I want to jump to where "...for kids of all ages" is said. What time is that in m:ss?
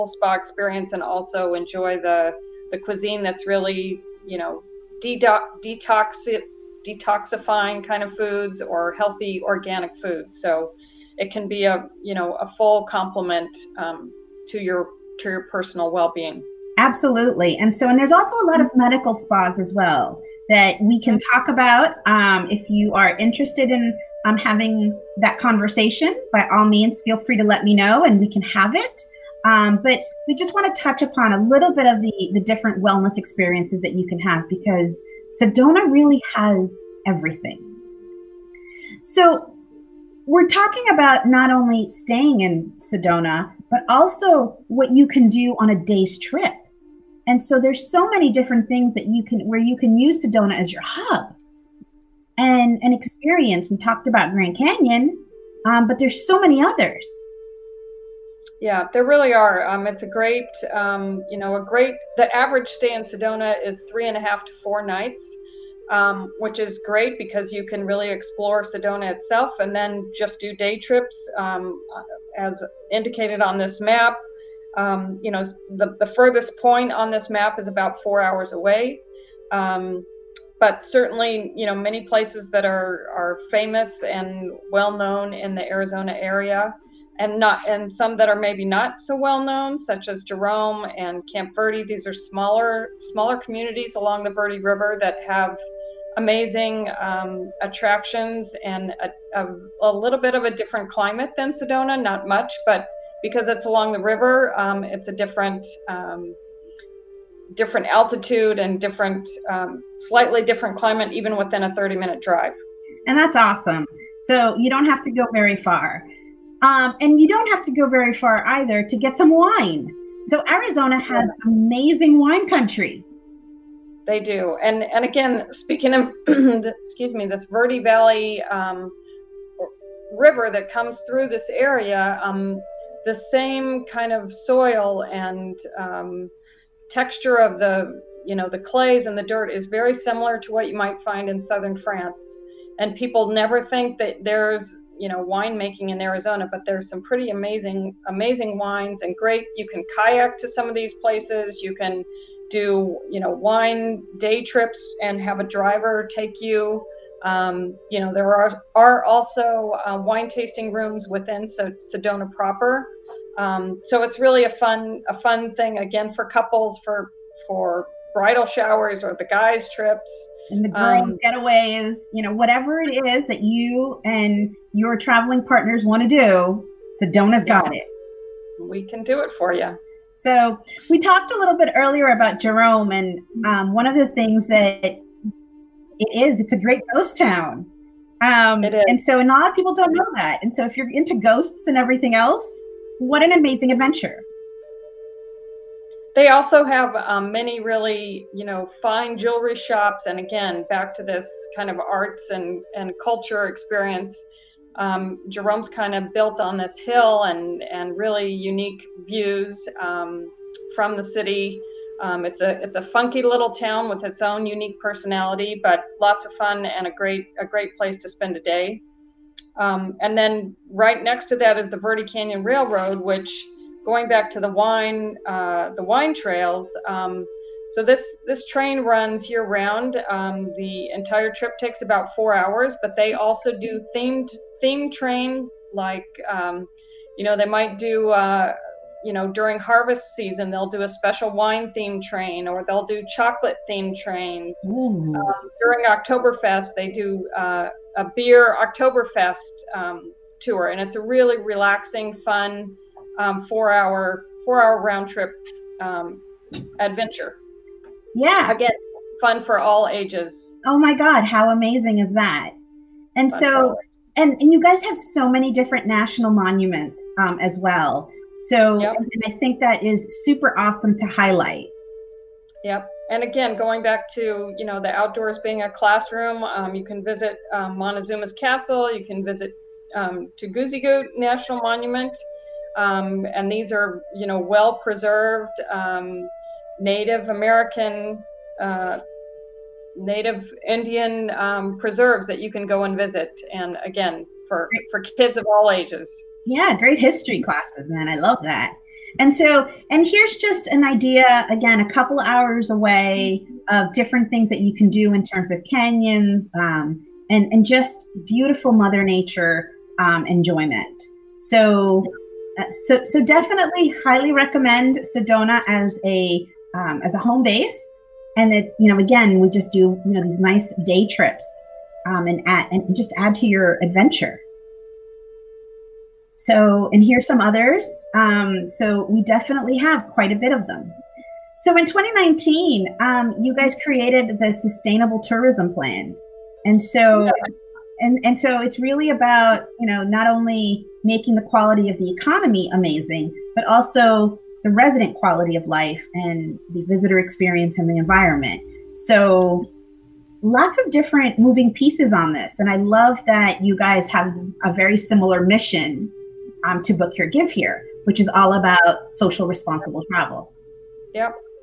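4:54.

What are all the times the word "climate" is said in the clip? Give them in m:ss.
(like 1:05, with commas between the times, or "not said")
1:40, 1:50.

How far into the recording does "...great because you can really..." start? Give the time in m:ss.
1:06.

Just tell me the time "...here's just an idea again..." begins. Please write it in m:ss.
5:00.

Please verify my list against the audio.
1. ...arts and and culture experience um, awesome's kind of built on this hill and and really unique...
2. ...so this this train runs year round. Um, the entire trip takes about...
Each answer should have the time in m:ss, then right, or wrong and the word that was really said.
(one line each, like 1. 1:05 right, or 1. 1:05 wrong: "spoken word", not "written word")
1. 3:21 wrong: "jerome", not "awesome"
2. 3:47 right.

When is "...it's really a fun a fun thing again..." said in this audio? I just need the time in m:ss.
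2:44.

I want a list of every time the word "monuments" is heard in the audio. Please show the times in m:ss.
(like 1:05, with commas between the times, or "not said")
4:26, 4:41.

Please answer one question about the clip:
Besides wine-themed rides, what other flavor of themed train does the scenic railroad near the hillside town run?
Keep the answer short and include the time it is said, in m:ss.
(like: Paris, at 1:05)
chocolate, at 4:03.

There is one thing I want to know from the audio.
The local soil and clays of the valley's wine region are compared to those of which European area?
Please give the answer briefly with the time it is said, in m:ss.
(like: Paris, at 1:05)
southern France, at 2:21.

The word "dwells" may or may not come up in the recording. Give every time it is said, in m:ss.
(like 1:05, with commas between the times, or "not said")
not said.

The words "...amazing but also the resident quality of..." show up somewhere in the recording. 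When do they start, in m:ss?
5:42.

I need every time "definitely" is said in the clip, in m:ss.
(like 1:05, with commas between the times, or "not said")
5:13, 5:29.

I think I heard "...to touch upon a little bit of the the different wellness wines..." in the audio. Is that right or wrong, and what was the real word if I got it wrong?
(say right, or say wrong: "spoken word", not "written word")
wrong: "experiences", not "wines".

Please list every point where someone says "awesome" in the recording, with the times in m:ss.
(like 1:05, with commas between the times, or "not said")
1:53, 4:30.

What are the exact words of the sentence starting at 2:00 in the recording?
So Arizona has amazing wine country.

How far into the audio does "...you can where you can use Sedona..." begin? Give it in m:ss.
0:49.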